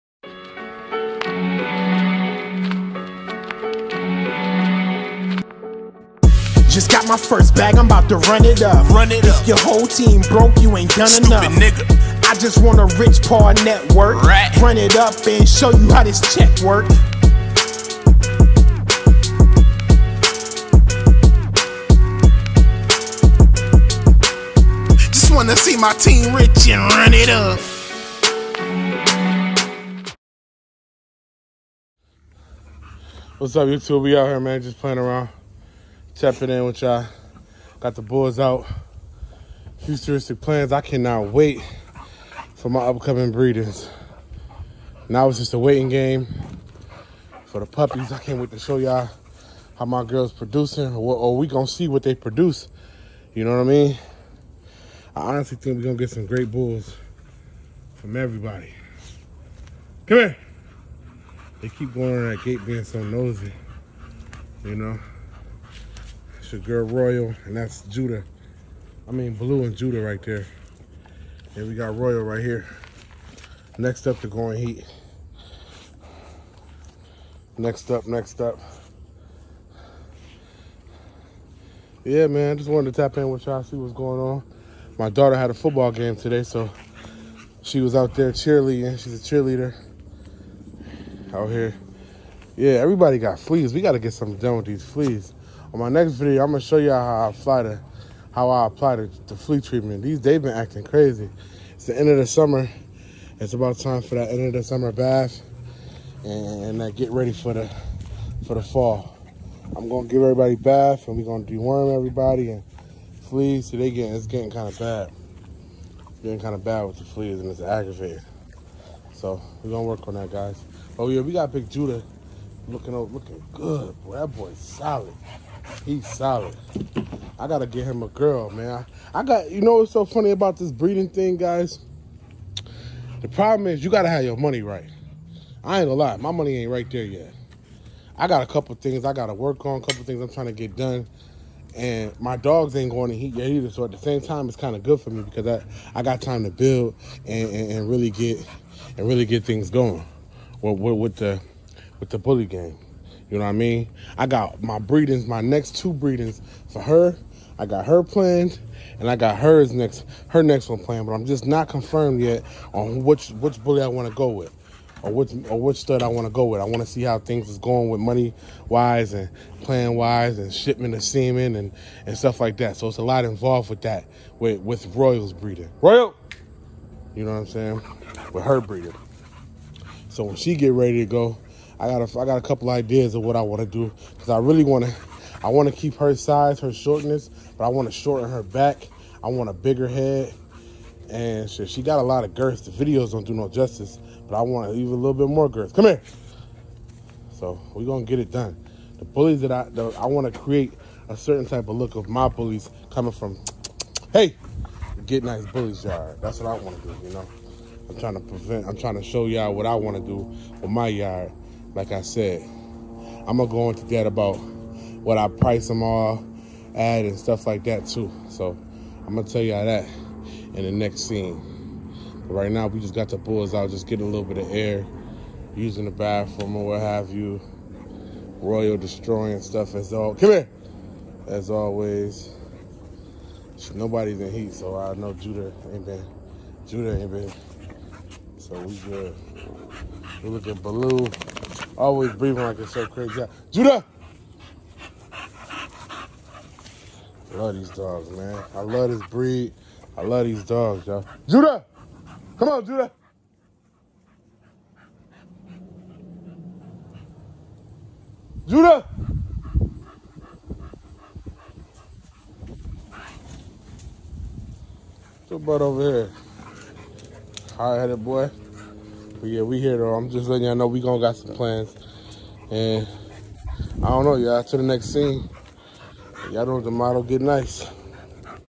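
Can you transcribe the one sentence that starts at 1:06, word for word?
your girl Royal, and that's Judah.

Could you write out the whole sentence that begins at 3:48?
Royal destroying stuff as all come here.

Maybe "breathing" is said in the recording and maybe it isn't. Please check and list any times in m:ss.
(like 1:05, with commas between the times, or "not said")
4:02.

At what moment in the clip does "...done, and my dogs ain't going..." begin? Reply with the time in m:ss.
2:20.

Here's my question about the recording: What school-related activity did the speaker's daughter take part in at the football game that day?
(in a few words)
Cheerleading.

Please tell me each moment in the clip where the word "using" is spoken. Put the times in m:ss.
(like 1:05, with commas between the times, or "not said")
3:45.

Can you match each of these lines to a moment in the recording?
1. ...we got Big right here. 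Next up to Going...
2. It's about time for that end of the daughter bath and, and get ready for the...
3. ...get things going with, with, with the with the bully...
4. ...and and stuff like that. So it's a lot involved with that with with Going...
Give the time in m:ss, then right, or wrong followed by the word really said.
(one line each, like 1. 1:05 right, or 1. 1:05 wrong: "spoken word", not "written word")
1. 1:11 wrong: "Royal", not "Big"
2. 1:43 wrong: "summer", not "daughter"
3. 2:29 right
4. 2:51 wrong: "Royals", not "Going".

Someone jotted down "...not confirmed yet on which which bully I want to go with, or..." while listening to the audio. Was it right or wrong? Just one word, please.
right.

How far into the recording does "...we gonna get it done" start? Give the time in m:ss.
3:17.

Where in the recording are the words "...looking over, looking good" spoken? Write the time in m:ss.
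2:02.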